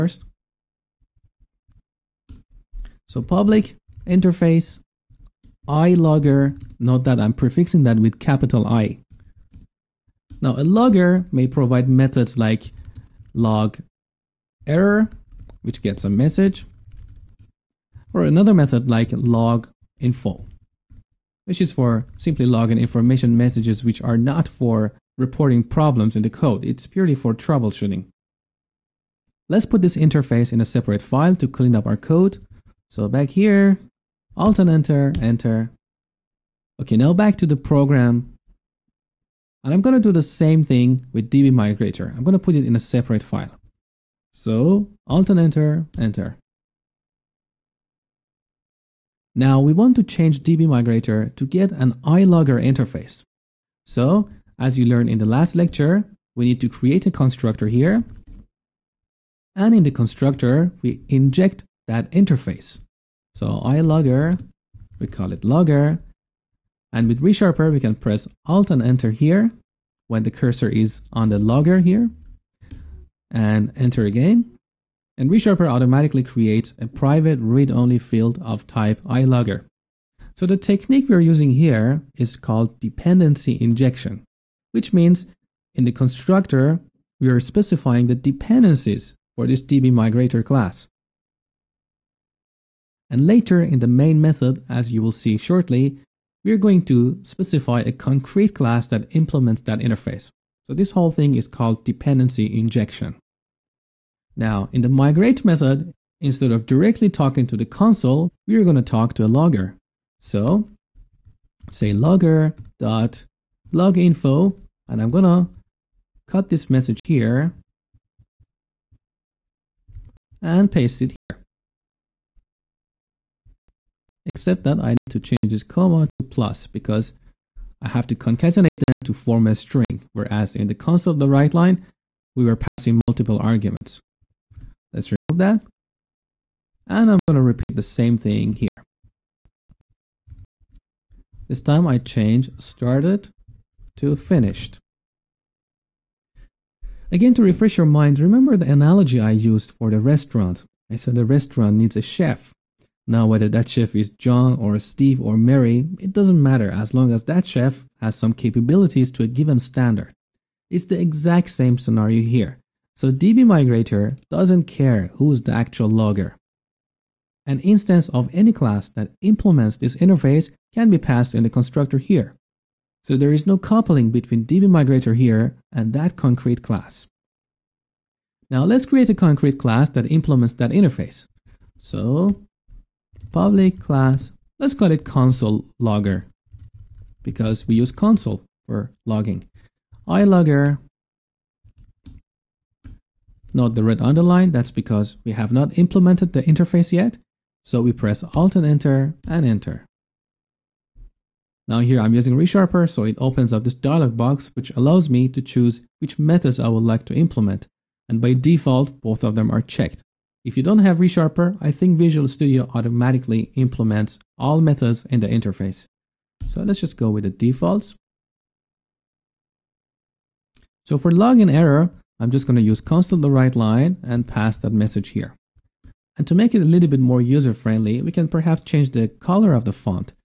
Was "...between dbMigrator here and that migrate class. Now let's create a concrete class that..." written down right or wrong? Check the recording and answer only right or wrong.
wrong.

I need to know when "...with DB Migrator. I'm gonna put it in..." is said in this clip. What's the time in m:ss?
0:41.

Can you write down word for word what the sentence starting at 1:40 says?
So this whole thing is called dependency injection.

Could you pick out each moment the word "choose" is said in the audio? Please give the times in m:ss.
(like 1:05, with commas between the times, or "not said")
3:25.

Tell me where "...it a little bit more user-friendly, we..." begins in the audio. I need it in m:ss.
3:46.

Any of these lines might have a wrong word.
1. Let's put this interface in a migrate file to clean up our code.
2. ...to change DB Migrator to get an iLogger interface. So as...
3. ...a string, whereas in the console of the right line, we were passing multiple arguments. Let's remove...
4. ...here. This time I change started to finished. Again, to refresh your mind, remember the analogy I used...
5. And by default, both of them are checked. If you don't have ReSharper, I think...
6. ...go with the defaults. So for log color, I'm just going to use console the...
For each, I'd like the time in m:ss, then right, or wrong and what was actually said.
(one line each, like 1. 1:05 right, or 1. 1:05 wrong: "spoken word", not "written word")
1. 0:29 wrong: "separate", not "migrate"
2. 0:49 right
3. 2:09 right
4. 2:18 right
5. 3:28 right
6. 3:36 wrong: "error", not "color".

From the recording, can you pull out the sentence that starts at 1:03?
So ILogger, we call it logger.